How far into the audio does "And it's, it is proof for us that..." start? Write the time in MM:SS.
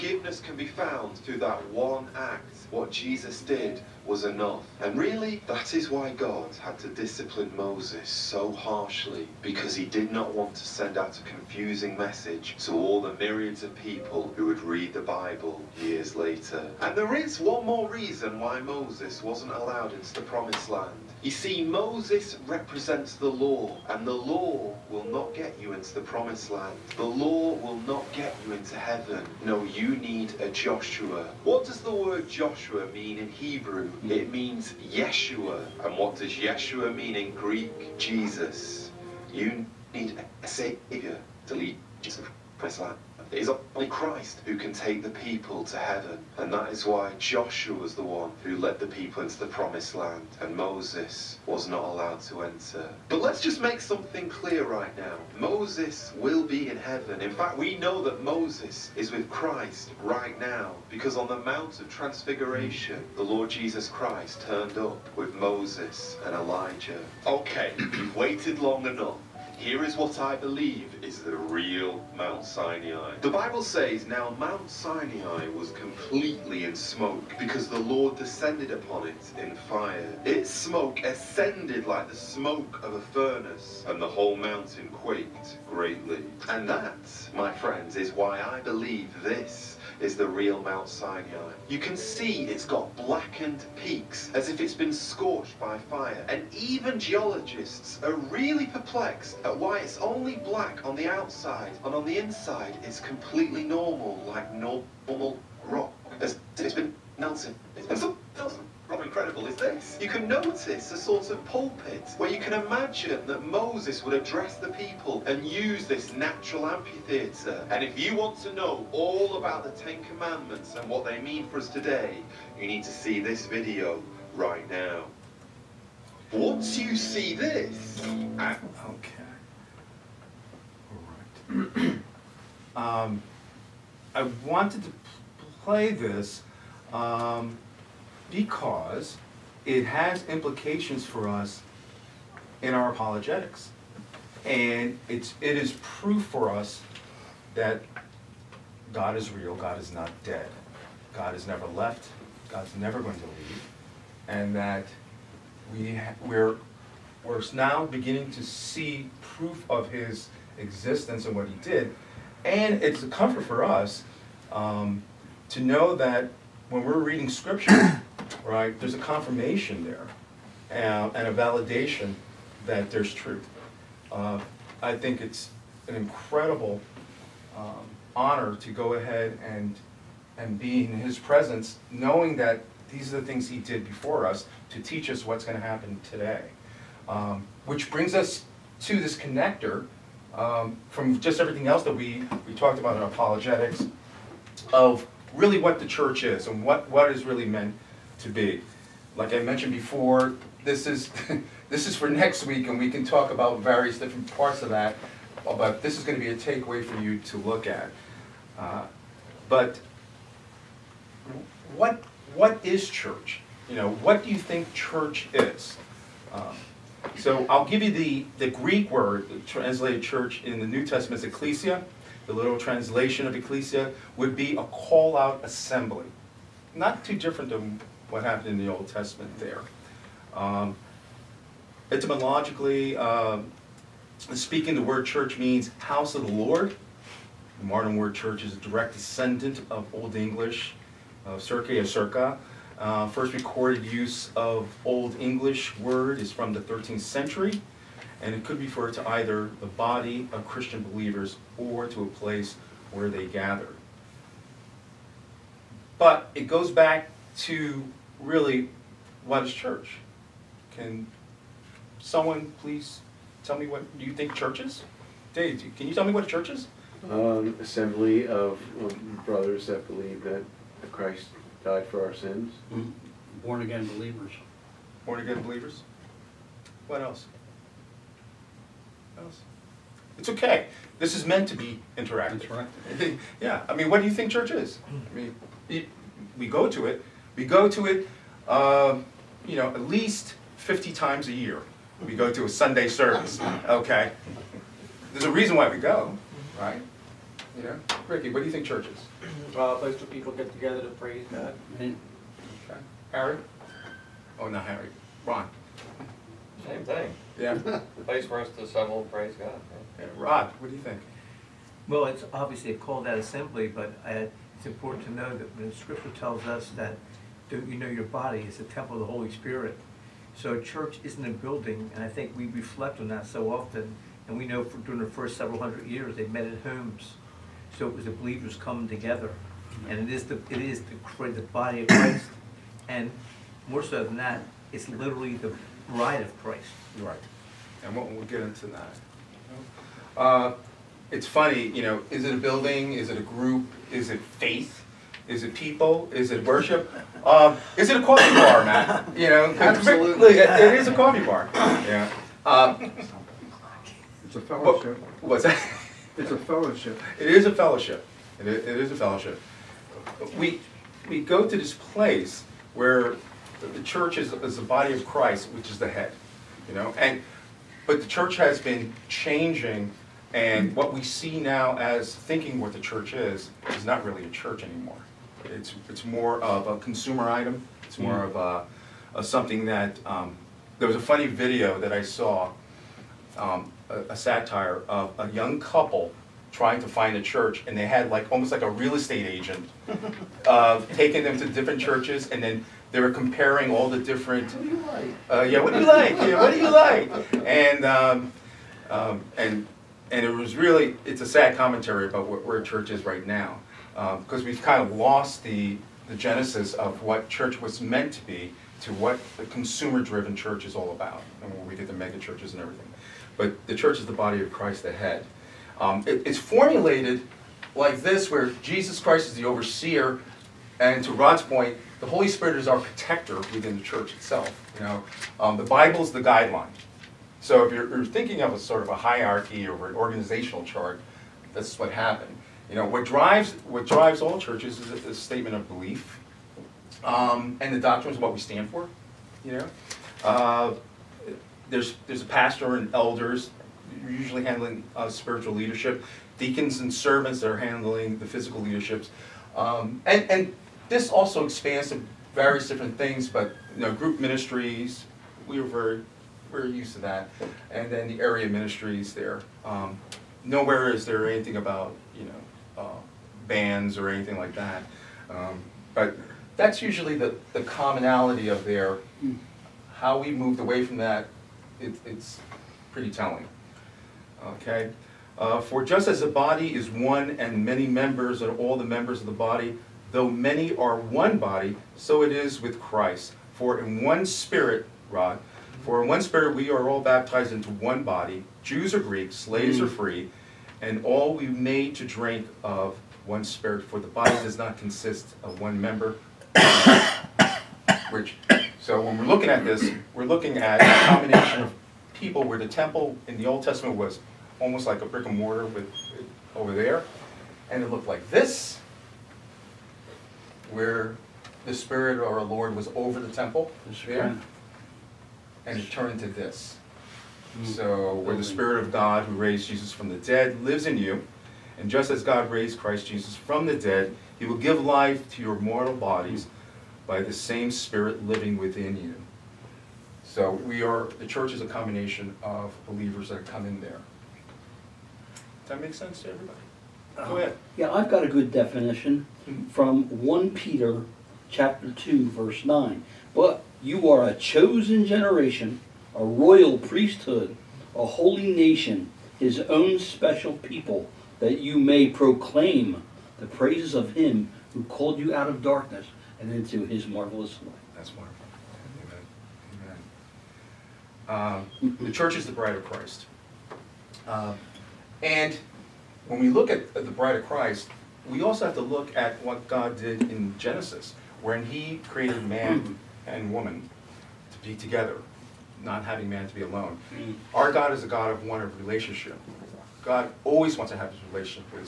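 02:24.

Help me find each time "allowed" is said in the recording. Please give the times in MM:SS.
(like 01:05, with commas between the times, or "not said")
00:19, 00:51.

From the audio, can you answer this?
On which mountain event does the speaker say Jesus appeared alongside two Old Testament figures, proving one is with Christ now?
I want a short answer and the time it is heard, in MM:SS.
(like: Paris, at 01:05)
Mount of Transfiguration, at 01:01.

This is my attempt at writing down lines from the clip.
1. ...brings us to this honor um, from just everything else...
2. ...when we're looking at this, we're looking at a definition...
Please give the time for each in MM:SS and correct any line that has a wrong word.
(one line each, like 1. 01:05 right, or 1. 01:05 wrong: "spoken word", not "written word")
1. 03:07 wrong: "connector", not "honor"
2. 08:18 wrong: "combination", not "definition".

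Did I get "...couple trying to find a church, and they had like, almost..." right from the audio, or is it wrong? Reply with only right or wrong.
right.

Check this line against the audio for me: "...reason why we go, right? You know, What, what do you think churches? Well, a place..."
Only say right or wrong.
wrong.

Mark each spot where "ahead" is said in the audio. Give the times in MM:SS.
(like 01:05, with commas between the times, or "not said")
02:58, 08:57.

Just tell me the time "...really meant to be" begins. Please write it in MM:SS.
03:17.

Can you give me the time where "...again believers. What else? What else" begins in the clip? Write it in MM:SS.
04:35.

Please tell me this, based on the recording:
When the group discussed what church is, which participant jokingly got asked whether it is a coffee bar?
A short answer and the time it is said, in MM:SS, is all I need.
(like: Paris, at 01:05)
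Matt, at 05:48.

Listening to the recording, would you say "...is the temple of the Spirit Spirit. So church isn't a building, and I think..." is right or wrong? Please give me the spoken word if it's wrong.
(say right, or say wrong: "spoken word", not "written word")
wrong: "Holy", not "Spirit".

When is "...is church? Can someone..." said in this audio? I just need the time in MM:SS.
04:19.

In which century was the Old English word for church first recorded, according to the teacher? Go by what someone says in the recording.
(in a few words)
13th century.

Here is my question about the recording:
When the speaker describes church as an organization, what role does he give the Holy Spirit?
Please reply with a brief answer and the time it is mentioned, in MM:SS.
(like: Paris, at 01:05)
protector, at 07:02.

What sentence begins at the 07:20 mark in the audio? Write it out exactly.
Uh, there's, there's a pastor and elders usually handling uh, spiritual leadership, deacons and servants that are handling the physical leaderships.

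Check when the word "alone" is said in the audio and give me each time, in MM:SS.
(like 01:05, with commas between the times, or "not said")
09:36.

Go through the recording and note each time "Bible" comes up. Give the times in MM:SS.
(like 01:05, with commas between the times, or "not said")
00:15, 01:13, 07:05.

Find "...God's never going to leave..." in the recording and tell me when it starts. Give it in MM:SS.
02:32.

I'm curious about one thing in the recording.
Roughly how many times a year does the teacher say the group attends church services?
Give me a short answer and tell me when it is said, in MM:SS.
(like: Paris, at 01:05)
50, at 04:50.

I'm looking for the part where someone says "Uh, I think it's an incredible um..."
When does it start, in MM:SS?
02:54.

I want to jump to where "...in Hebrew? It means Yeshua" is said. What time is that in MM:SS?
00:33.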